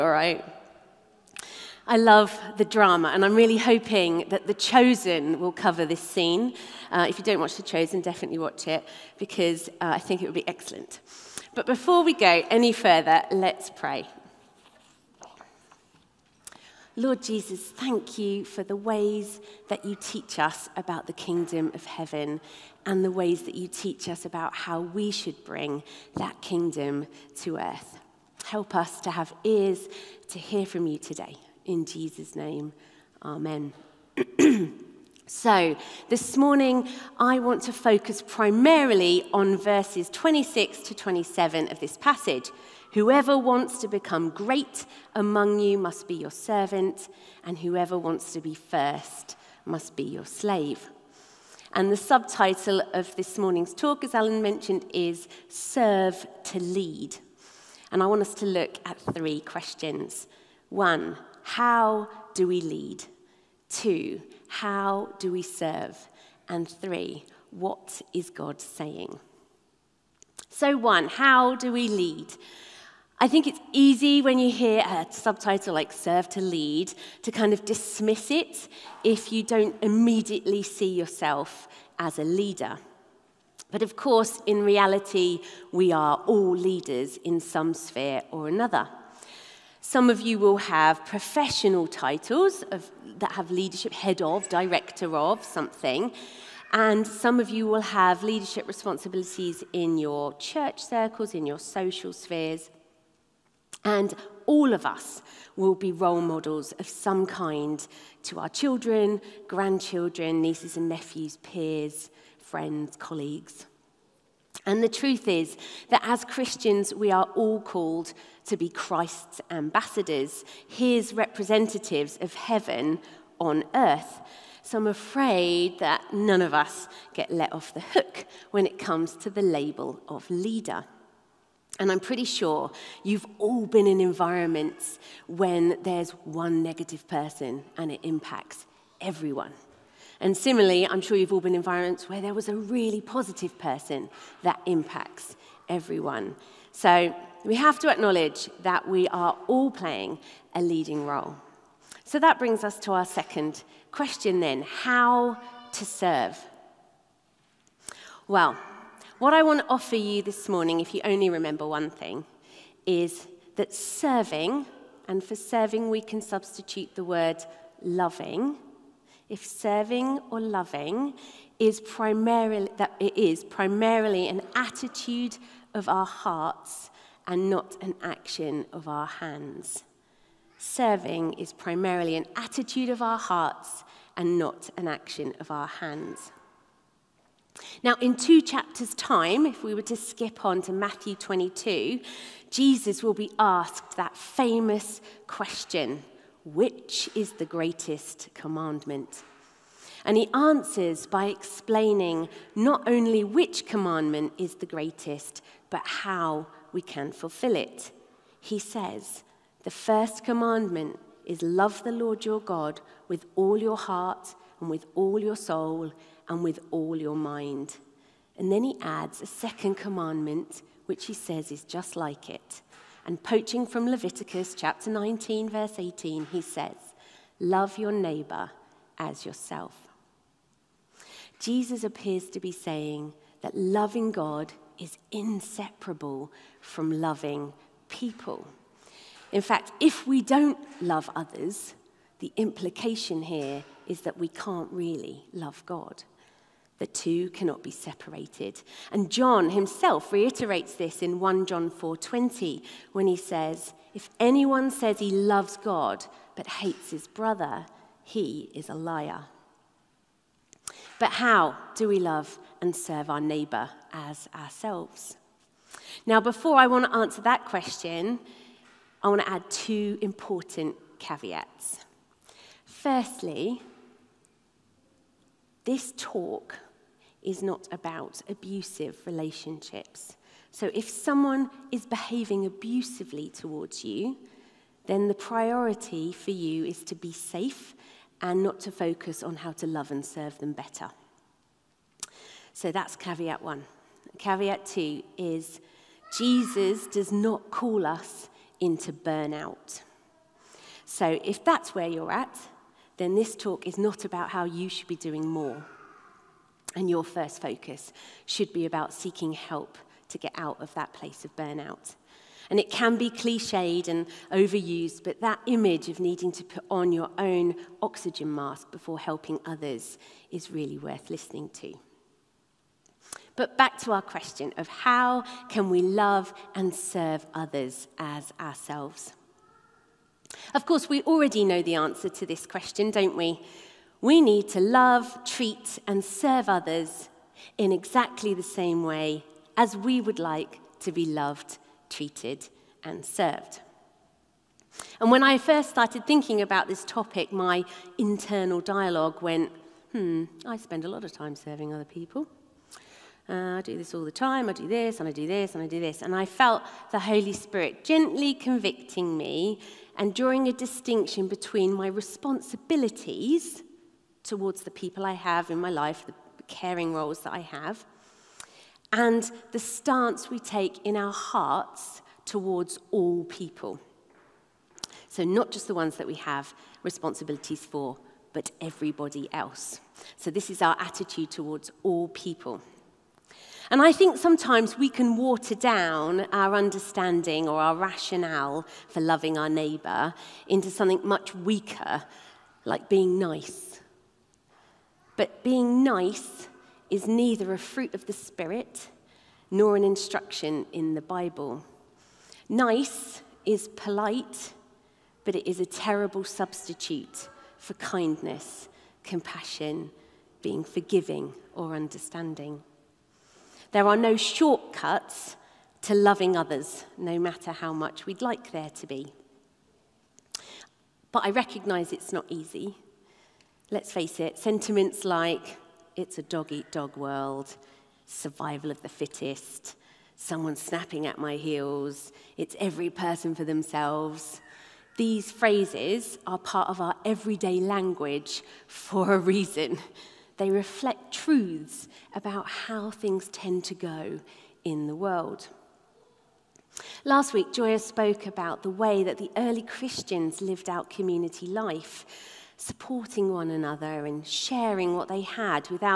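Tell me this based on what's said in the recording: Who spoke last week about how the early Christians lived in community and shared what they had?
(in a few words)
Joya.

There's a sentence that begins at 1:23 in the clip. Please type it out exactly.
But of course, in reality, we are all leaders in some sphere or another.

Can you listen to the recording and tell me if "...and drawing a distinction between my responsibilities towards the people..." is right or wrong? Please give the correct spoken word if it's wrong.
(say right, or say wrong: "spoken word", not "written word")
right.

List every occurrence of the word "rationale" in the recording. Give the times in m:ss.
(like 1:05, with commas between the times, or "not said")
6:27.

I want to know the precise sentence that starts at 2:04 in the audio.
So I'm afraid that none of us get let off the hook when it comes to the label of leader.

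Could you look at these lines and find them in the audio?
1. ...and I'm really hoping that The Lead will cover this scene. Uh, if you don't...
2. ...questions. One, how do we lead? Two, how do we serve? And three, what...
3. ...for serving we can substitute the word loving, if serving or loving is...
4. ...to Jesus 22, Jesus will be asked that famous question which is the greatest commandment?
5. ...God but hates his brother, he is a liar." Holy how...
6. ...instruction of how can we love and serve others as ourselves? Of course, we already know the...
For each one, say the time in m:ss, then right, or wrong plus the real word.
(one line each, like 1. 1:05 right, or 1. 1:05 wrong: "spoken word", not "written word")
1. 0:03 wrong: "Chosen", not "Lead"
2. 0:59 right
3. 2:45 right
4. 3:10 wrong: "Matthew", not "Jesus"
5. 4:15 wrong: "But", not "Holy"
6. 5:24 wrong: "question", not "instruction".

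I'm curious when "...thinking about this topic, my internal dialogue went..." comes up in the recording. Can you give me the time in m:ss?
5:46.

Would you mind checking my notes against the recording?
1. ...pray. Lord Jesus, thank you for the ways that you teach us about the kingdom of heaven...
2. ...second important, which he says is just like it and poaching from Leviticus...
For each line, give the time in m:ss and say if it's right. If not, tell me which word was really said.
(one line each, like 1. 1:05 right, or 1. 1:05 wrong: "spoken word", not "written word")
1. 0:13 right
2. 3:39 wrong: "commandment", not "important".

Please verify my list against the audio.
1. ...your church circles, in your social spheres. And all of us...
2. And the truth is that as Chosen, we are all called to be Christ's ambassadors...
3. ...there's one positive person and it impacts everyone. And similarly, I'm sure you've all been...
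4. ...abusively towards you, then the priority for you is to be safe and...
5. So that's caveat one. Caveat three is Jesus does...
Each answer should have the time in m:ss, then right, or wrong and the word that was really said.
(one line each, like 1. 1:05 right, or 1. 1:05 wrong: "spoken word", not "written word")
1. 1:39 right
2. 1:54 wrong: "Christians", not "Chosen"
3. 2:15 wrong: "negative", not "positive"
4. 4:42 right
5. 4:52 wrong: "two", not "three".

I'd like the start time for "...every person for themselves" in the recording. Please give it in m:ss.
7:12.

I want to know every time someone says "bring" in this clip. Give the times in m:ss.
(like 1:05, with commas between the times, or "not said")
0:25, 2:32.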